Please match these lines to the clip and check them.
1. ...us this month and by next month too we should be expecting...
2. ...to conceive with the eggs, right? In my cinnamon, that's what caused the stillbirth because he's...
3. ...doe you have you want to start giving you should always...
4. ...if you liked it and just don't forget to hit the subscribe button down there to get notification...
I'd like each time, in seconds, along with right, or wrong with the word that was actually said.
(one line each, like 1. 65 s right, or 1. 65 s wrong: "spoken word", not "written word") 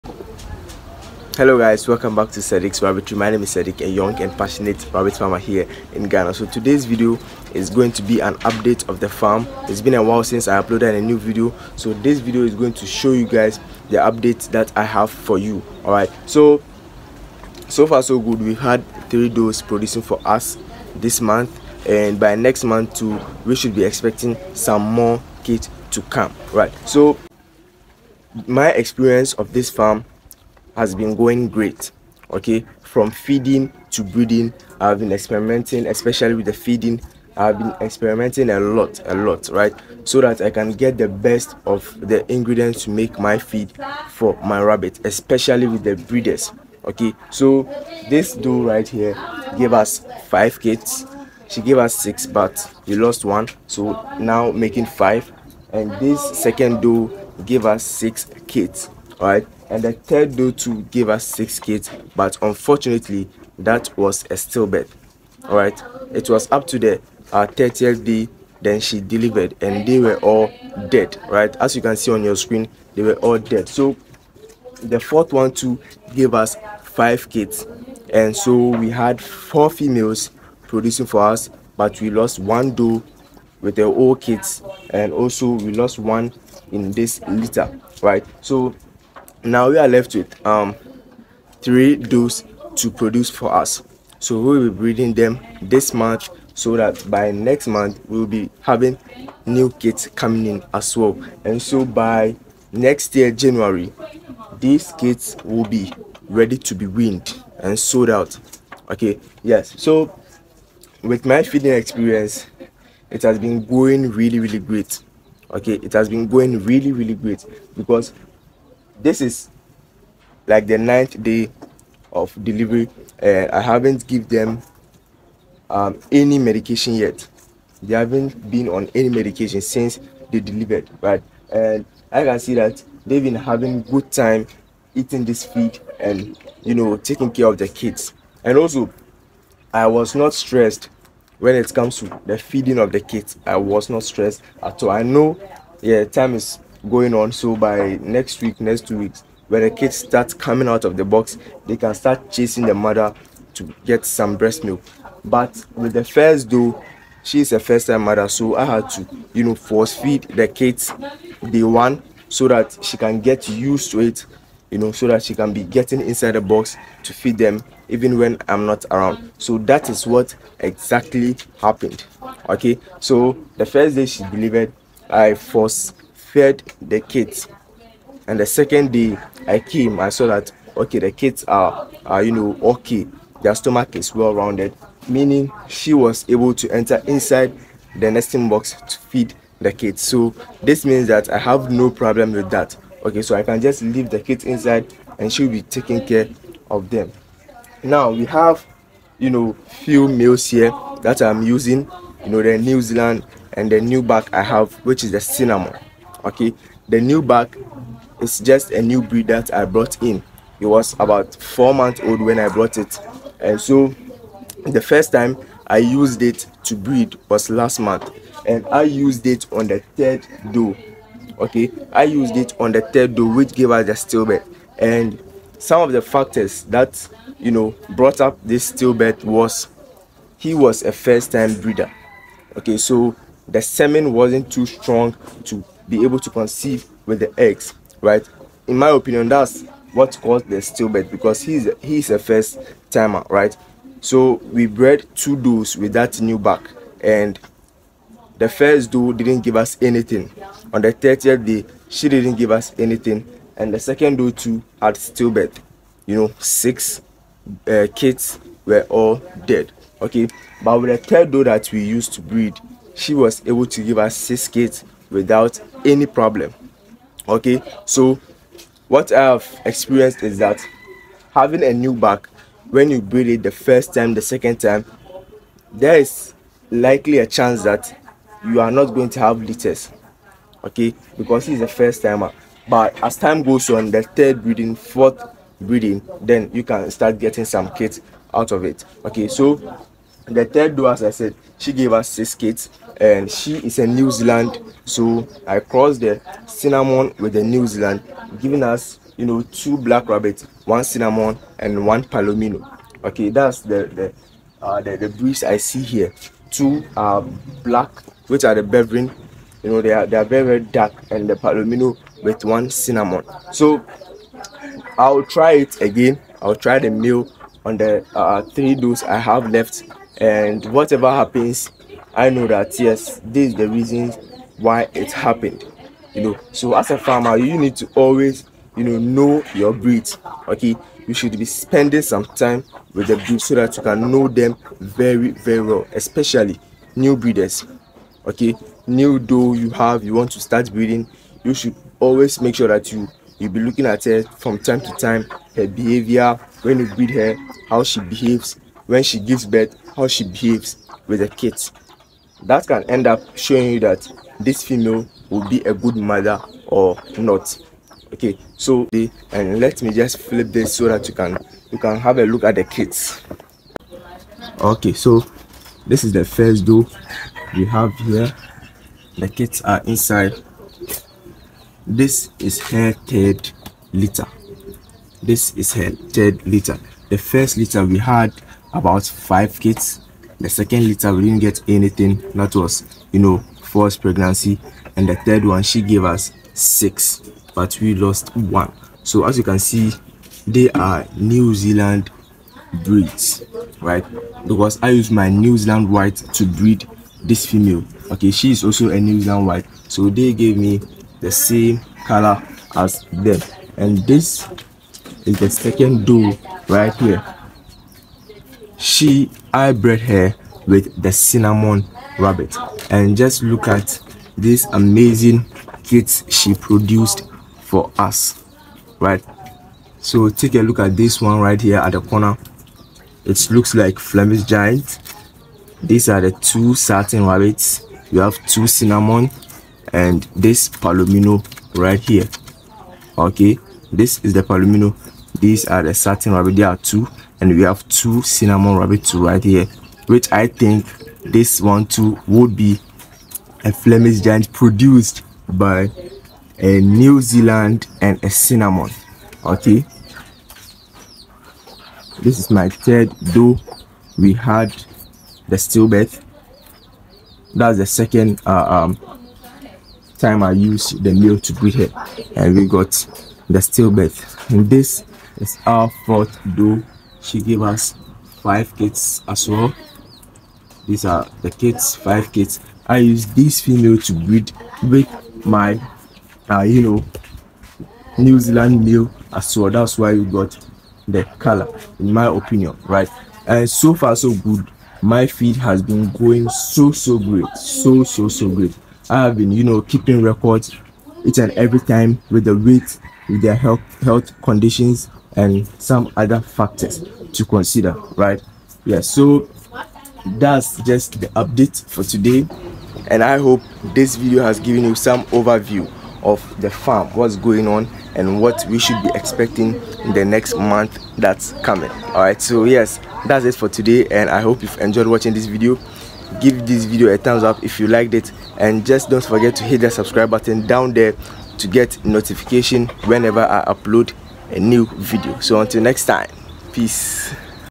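1. 20 s right
2. 236 s wrong: "opinion", not "cinnamon"
3. 339 s wrong: "breeding", not "giving"
4. 517 s right.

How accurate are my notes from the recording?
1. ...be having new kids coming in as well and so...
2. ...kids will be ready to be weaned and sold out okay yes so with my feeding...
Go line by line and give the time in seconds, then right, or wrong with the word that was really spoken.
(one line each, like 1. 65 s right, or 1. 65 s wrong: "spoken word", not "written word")
1. 98 s right
2. 104 s right.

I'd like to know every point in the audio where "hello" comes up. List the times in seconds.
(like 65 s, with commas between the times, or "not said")
1 s.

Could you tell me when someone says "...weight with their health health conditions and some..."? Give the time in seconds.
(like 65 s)
492 s.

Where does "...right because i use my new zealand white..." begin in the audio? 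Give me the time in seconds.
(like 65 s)
393 s.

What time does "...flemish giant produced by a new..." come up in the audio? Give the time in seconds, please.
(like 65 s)
443 s.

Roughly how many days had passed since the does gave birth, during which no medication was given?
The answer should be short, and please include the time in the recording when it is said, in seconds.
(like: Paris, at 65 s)
9, at 120 s.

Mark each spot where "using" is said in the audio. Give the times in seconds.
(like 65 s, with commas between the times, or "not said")
201 s.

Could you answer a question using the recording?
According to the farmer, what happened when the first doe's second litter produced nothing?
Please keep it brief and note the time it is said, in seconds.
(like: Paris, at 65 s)
false pregnancy, at 383 s.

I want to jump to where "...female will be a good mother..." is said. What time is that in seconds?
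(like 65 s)
354 s.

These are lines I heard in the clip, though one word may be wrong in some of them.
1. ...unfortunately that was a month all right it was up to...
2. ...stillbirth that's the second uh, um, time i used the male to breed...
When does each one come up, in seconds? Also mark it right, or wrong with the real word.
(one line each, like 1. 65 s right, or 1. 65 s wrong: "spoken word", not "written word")
1. 62 s wrong: "stillbirth", not "month"
2. 455 s right.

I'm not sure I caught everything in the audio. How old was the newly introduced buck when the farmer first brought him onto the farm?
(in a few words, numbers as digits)
4 months.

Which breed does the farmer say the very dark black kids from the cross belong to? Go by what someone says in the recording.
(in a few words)
Beveren.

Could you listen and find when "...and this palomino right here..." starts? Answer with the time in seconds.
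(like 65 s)
429 s.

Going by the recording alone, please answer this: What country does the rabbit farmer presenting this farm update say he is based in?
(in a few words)
Ghana.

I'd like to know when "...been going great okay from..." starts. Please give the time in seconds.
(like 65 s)
30 s.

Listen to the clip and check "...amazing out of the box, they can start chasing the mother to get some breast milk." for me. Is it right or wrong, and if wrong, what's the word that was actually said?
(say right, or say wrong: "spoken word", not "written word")
wrong: "coming", not "amazing".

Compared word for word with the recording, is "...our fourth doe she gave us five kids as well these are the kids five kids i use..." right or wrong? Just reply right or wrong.
right.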